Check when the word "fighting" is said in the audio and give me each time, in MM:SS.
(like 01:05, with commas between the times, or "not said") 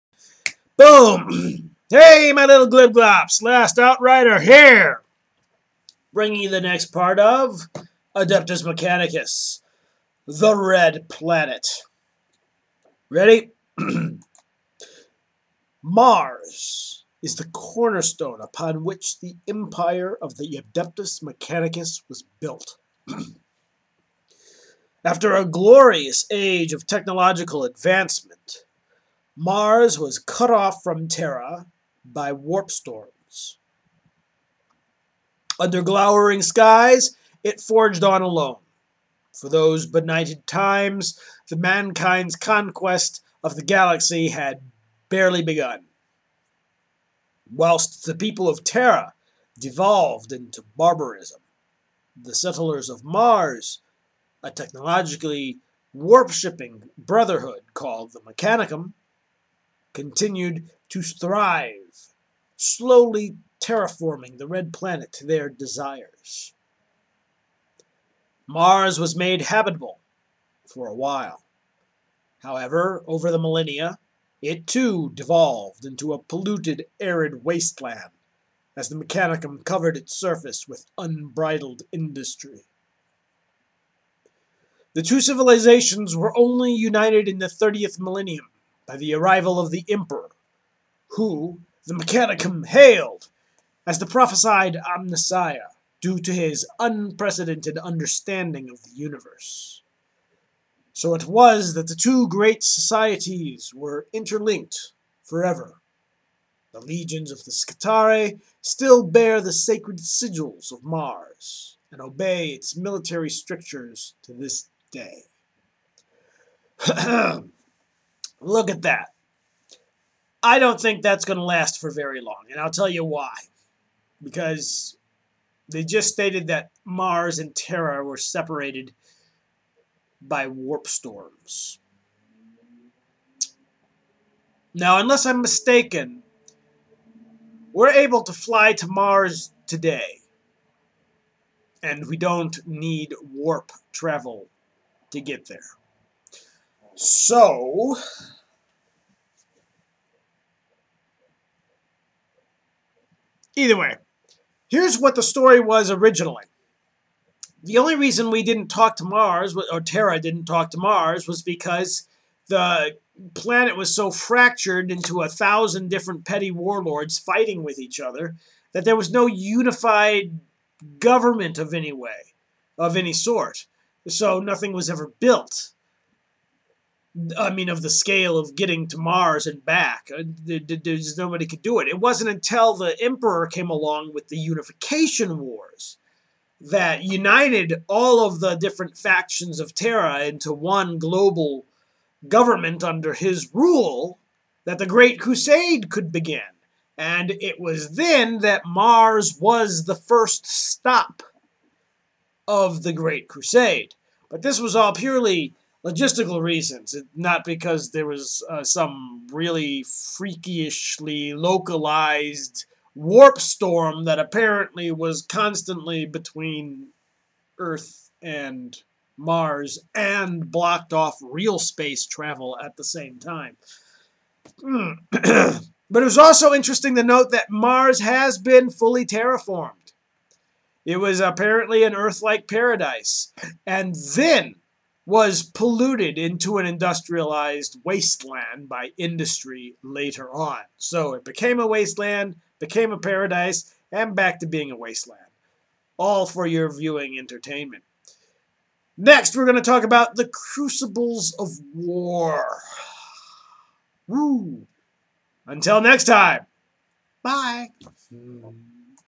02:47.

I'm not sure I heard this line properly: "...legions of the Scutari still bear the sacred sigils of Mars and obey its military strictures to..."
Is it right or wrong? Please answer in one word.
right.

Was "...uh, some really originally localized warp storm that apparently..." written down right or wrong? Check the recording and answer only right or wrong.
wrong.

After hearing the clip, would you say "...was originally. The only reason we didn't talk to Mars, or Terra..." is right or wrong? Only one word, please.
right.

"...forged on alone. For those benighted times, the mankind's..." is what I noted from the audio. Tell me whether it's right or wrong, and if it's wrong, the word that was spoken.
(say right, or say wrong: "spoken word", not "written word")
right.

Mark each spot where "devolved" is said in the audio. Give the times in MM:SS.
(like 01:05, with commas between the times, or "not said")
00:49, 01:15.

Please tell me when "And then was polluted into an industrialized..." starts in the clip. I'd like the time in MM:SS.
03:53.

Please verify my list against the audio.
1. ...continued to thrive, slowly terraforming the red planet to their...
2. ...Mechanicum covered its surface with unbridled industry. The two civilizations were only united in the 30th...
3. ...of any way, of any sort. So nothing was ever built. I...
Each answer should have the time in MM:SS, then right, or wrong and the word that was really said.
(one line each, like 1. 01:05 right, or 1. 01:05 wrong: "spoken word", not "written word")
1. 00:59 right
2. 01:18 right
3. 02:51 right.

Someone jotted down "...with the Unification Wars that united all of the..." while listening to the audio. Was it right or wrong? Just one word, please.
right.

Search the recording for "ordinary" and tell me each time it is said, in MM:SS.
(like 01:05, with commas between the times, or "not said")
not said.